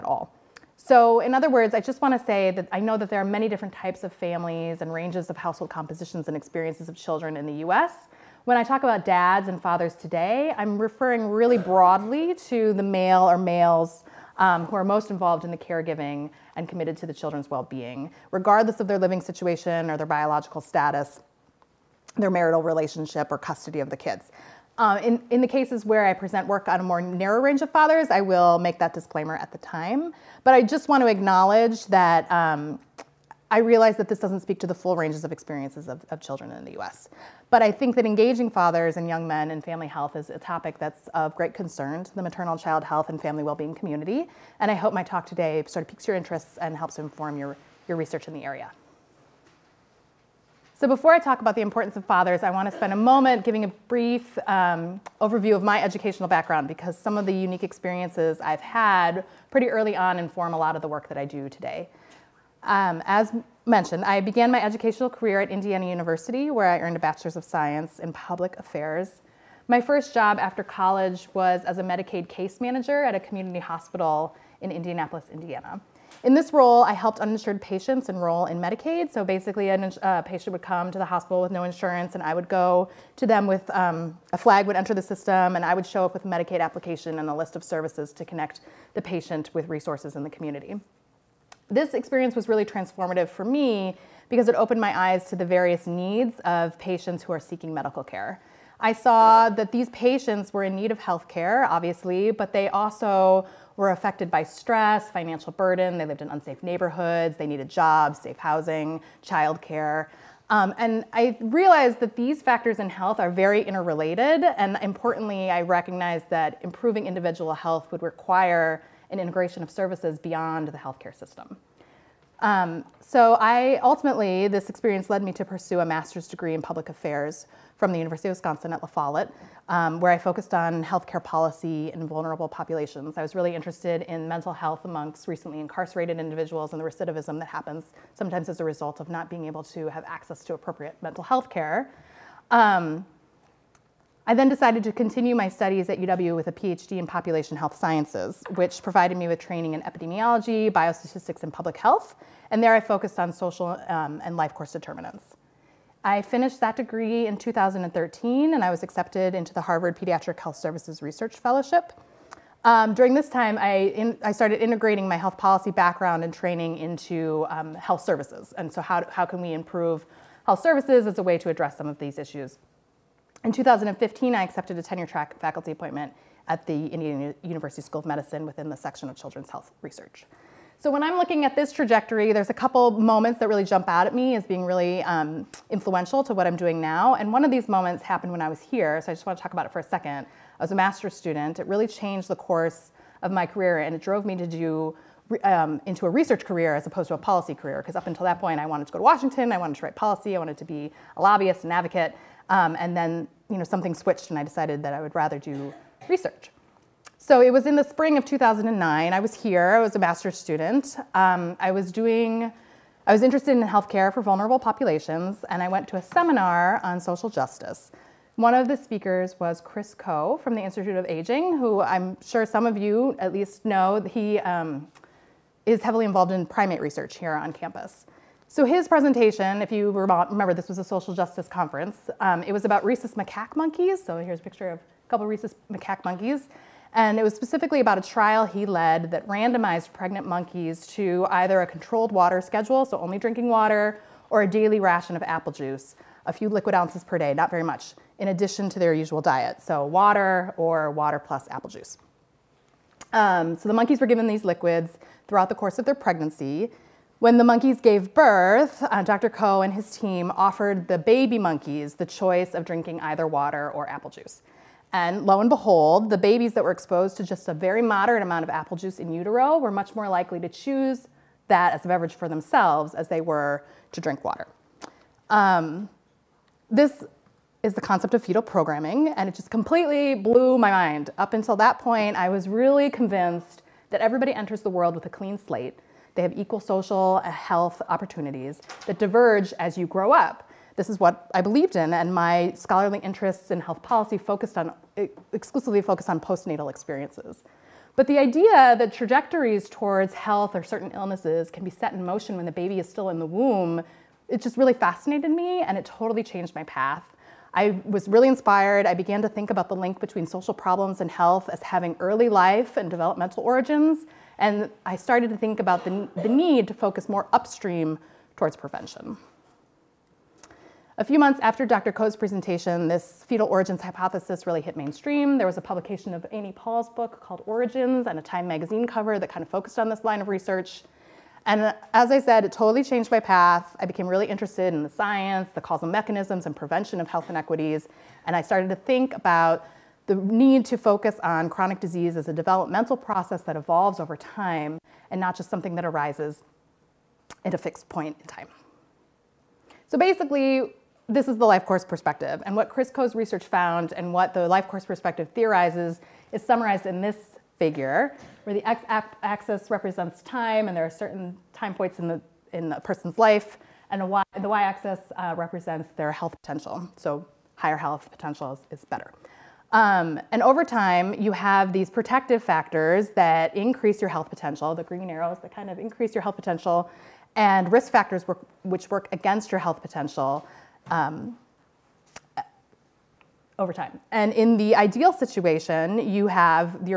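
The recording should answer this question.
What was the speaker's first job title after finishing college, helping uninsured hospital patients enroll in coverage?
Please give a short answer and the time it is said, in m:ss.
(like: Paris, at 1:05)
Medicaid case manager, at 1:11.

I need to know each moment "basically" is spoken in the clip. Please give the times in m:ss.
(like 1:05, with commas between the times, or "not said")
1:19, 5:49.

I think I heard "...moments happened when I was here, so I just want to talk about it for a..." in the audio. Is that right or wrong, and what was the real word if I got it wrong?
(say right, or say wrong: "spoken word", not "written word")
right.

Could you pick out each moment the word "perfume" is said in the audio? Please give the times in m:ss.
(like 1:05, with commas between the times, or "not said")
not said.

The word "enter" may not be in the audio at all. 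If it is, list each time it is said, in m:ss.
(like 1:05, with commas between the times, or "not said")
1:24, 4:44.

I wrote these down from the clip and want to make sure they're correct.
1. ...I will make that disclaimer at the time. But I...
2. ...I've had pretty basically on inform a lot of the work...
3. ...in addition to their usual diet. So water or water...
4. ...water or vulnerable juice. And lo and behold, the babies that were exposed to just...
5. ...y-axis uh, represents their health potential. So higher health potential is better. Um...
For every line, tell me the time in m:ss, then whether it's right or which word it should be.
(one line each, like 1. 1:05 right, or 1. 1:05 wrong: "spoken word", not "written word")
1. 0:28 right
2. 0:58 wrong: "early", not "basically"
3. 4:08 right
4. 4:23 wrong: "apple", not "vulnerable"
5. 6:04 right.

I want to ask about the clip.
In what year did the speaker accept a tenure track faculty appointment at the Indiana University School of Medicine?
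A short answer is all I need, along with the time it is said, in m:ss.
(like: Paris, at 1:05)
2015, at 2:53.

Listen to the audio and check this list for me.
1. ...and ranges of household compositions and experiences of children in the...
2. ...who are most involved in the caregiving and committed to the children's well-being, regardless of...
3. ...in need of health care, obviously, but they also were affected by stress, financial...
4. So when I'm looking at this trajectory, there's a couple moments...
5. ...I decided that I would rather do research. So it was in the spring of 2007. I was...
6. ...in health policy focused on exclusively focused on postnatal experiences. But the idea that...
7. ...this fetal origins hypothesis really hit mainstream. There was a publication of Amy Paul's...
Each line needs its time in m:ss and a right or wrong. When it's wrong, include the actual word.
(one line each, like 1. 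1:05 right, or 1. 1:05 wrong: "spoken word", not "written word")
1. 0:04 right
2. 0:14 right
3. 1:40 right
4. 3:00 right
5. 3:24 wrong: "2009", not "2007"
6. 4:53 right
7. 5:22 right.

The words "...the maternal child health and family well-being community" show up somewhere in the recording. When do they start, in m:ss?
0:42.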